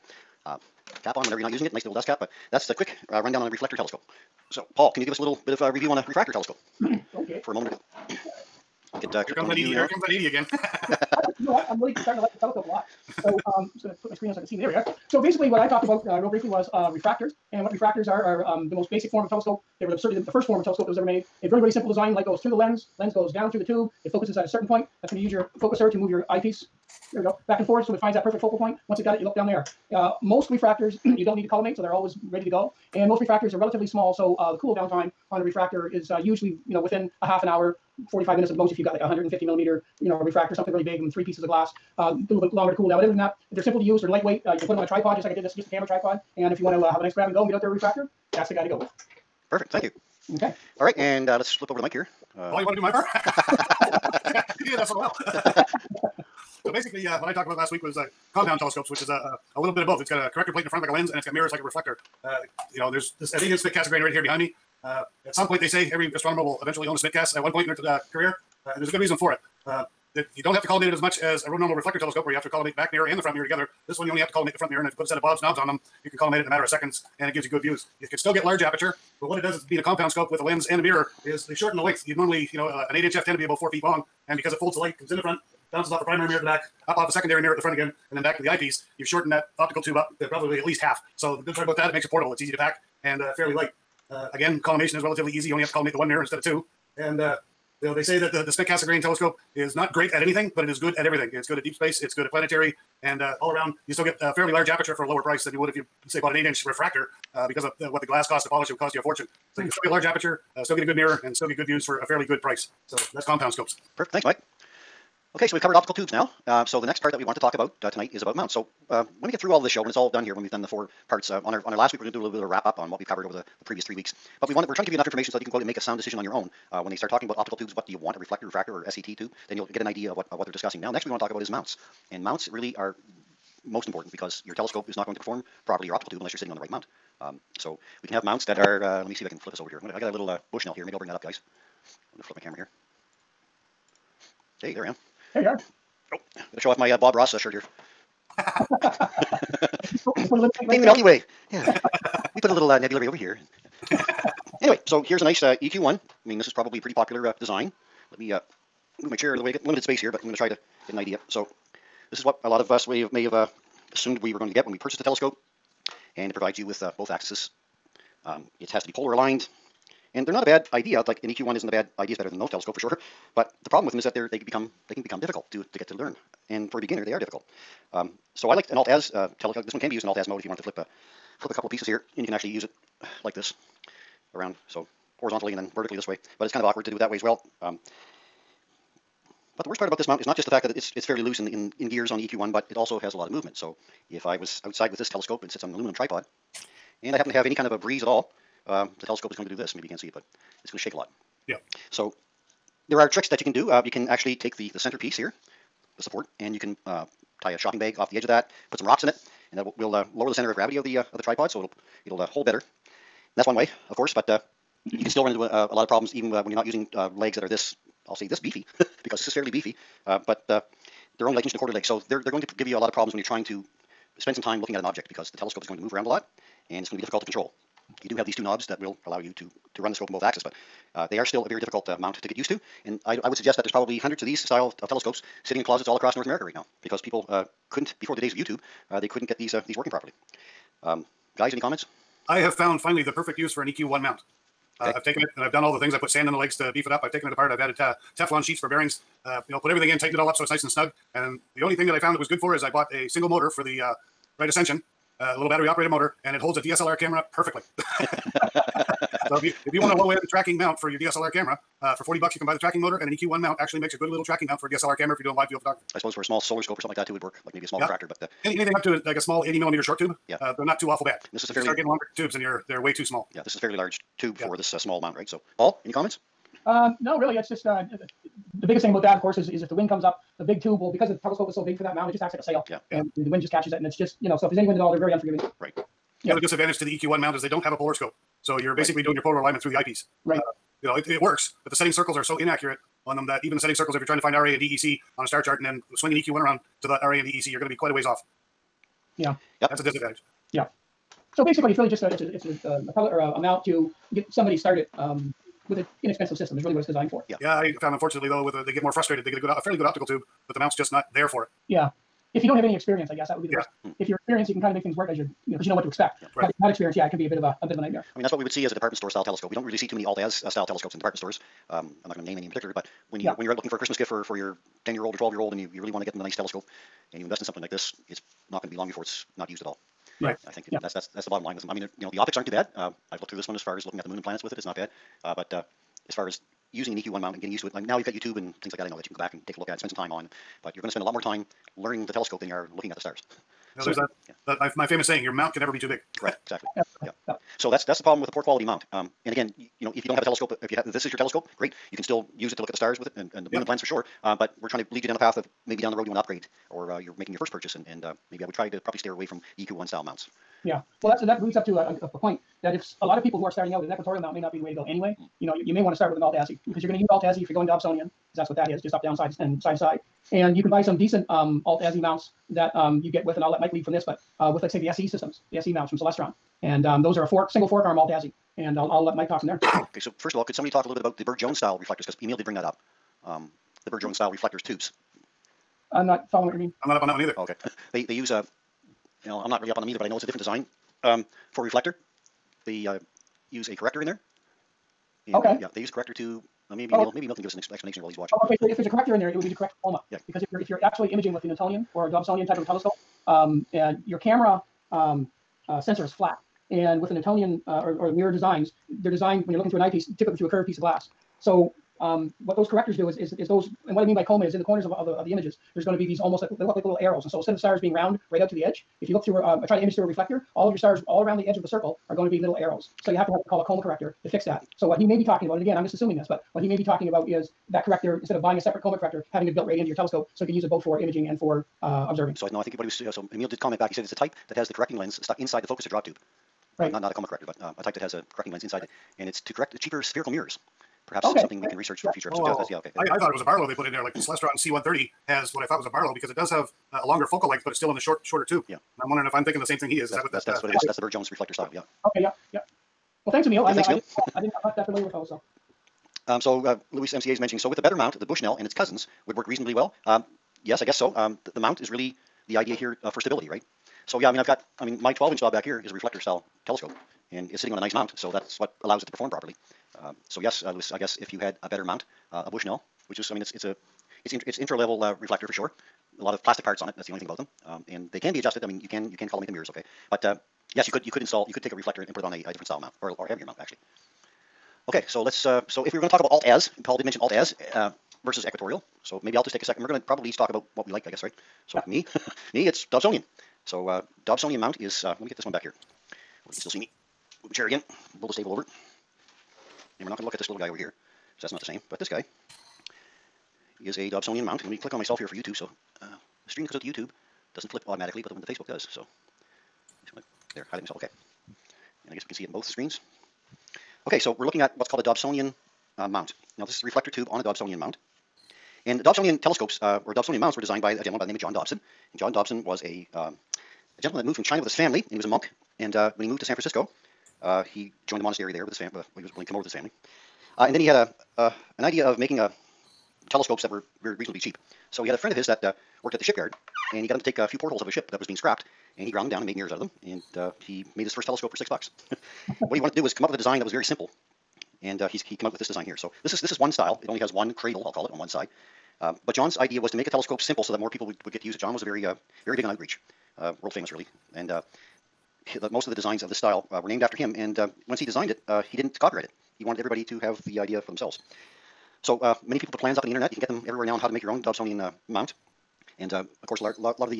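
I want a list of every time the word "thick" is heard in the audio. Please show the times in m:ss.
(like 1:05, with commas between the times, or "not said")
1:03.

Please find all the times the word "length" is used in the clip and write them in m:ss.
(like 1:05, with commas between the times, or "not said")
1:21, 7:27.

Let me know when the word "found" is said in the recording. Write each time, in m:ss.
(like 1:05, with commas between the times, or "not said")
4:02, 4:11, 5:07.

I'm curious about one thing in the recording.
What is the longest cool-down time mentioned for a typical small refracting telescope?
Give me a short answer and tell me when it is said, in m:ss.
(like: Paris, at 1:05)
45 minutes, at 0:38.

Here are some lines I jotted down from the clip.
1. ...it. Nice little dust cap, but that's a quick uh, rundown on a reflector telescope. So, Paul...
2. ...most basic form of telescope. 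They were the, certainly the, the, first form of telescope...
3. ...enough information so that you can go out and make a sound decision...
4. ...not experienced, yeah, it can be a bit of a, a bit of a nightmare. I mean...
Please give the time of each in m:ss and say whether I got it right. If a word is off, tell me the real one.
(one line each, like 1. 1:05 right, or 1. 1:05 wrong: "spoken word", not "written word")
1. 0:01 right
2. 0:18 right
3. 2:04 right
4. 5:16 right.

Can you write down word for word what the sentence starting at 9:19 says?
He wanted everybody to have the idea for themselves.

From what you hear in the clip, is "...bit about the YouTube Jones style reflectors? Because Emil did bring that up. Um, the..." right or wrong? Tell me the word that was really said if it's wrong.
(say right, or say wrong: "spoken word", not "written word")
wrong: "Bird", not "YouTube".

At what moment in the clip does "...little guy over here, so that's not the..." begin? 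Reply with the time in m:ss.
8:20.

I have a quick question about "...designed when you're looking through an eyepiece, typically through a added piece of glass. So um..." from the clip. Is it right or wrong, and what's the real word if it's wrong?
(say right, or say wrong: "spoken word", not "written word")
wrong: "curved", not "added".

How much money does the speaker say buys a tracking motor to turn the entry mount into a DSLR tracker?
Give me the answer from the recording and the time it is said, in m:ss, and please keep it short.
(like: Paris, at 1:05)
40 dollars, at 4:22.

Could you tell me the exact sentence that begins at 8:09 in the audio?
So maybe I'll just take a second.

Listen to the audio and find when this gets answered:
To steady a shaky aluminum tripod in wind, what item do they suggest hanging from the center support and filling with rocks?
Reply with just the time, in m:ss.
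3:27.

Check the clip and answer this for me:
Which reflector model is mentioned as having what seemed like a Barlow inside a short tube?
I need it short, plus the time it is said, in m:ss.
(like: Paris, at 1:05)
Celestron C130, at 7:24.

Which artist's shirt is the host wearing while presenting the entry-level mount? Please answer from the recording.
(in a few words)
Bob Ross.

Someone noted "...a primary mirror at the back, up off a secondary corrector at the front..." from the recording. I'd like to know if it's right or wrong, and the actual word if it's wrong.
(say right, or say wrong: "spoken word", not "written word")
wrong: "mirror", not "corrector".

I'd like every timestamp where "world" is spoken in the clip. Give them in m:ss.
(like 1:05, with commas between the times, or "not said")
9:13.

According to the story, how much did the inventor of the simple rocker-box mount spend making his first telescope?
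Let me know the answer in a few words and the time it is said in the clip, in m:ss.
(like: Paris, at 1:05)
6 dollars, at 9:01.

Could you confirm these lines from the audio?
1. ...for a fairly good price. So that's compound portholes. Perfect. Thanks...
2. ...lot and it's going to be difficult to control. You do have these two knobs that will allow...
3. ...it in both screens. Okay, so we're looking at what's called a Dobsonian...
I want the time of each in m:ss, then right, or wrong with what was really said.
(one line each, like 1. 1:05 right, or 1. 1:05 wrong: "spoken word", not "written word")
1. 1:51 wrong: "scopes", not "portholes"
2. 3:46 right
3. 8:32 right.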